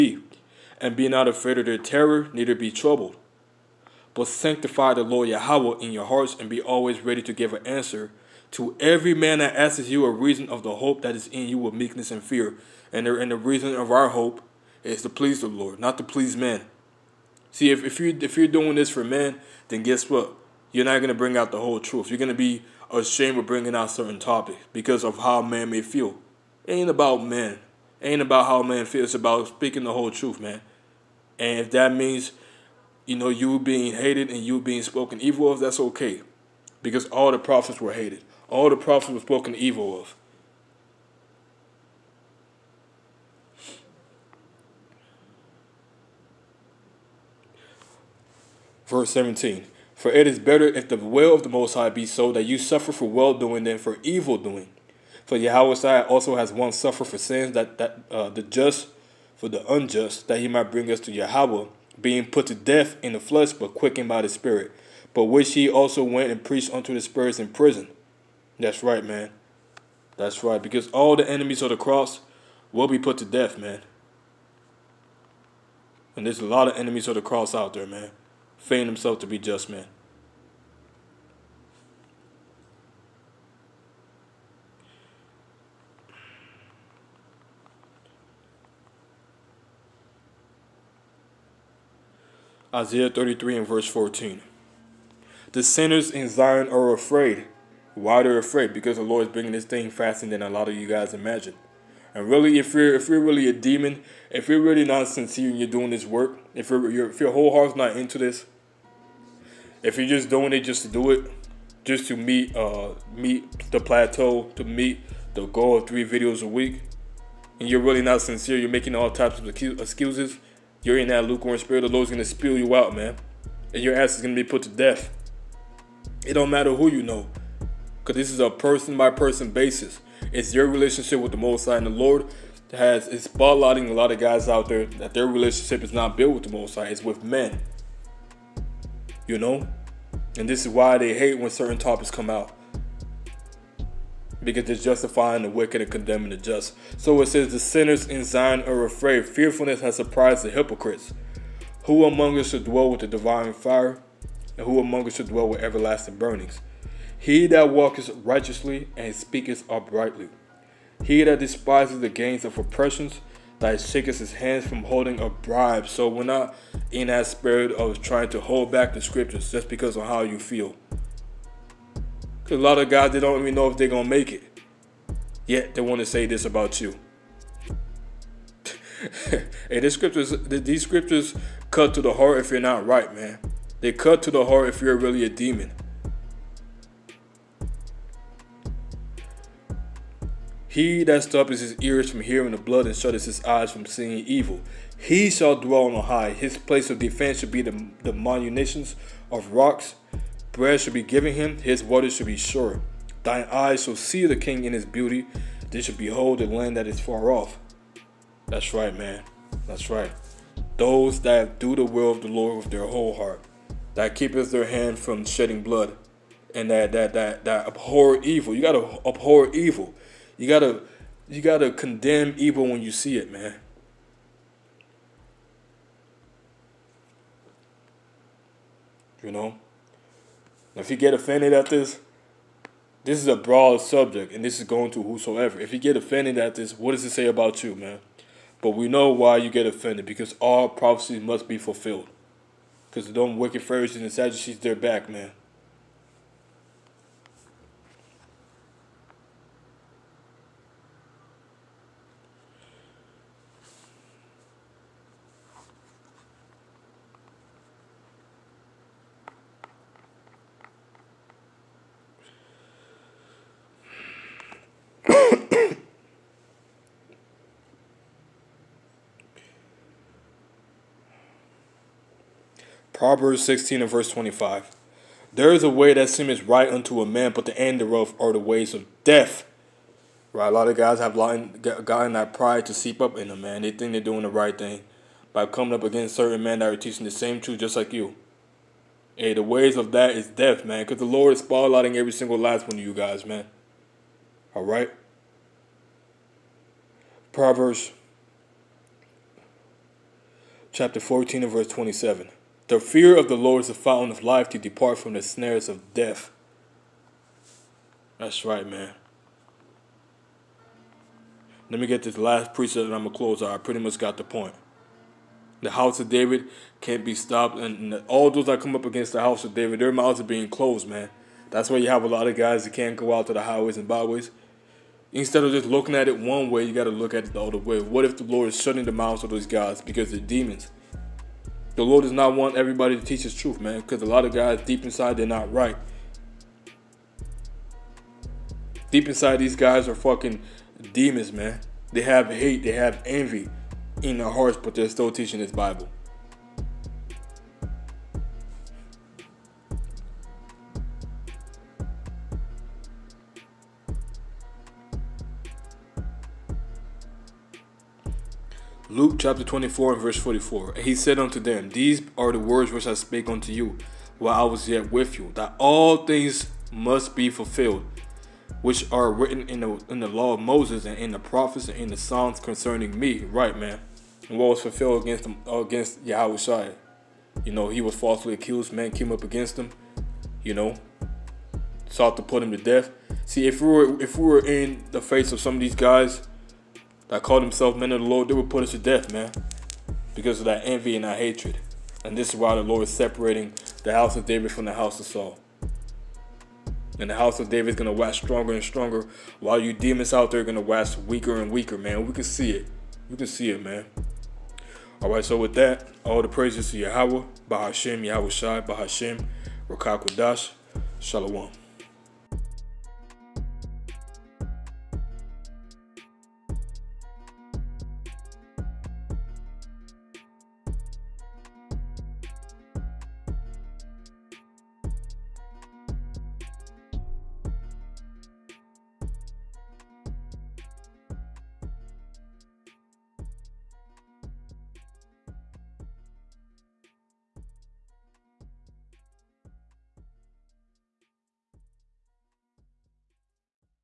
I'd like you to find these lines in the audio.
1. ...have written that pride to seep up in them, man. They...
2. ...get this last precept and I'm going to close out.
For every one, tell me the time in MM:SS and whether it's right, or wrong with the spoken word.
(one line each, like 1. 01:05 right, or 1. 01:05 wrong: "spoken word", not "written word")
1. 04:40 wrong: "gotten", not "written"
2. 05:11 right.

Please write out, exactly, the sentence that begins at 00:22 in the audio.
You're going to be ashamed of bringing out certain topics because of how a man may feel.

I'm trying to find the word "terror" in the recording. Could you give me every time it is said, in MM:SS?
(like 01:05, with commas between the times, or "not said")
00:01.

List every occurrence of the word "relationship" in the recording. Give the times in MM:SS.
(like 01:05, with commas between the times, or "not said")
02:10, 02:15.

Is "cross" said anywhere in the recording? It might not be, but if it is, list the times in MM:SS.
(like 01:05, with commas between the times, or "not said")
01:11, 01:17.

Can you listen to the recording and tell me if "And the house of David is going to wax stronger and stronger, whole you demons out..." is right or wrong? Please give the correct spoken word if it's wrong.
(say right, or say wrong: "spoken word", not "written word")
wrong: "while", not "whole".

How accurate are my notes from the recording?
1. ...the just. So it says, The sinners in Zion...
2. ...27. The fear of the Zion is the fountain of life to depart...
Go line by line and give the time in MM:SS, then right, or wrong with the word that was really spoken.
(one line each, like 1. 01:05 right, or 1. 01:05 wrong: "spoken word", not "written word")
1. 02:26 right
2. 05:01 wrong: "Lord", not "Zion".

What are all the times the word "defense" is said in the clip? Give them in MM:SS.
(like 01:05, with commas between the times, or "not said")
03:16.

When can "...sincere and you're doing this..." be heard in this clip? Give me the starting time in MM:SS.
01:45.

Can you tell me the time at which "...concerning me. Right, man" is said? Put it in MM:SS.
06:12.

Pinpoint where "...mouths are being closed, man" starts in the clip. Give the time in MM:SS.
05:19.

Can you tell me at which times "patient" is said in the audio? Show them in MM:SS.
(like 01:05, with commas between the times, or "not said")
not said.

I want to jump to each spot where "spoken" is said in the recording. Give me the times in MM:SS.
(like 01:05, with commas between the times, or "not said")
00:34, 00:39.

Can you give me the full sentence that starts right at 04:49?
Hey, the ways of that is death, man, because the Lord is spotlighting every single last one of you guys, man.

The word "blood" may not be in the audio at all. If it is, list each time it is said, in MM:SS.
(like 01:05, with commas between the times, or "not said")
03:12, 03:35.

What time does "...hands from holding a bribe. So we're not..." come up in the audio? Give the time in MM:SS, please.
02:44.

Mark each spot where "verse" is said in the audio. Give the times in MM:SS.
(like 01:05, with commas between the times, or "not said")
00:48, 01:33, 04:33, 05:01, 06:00.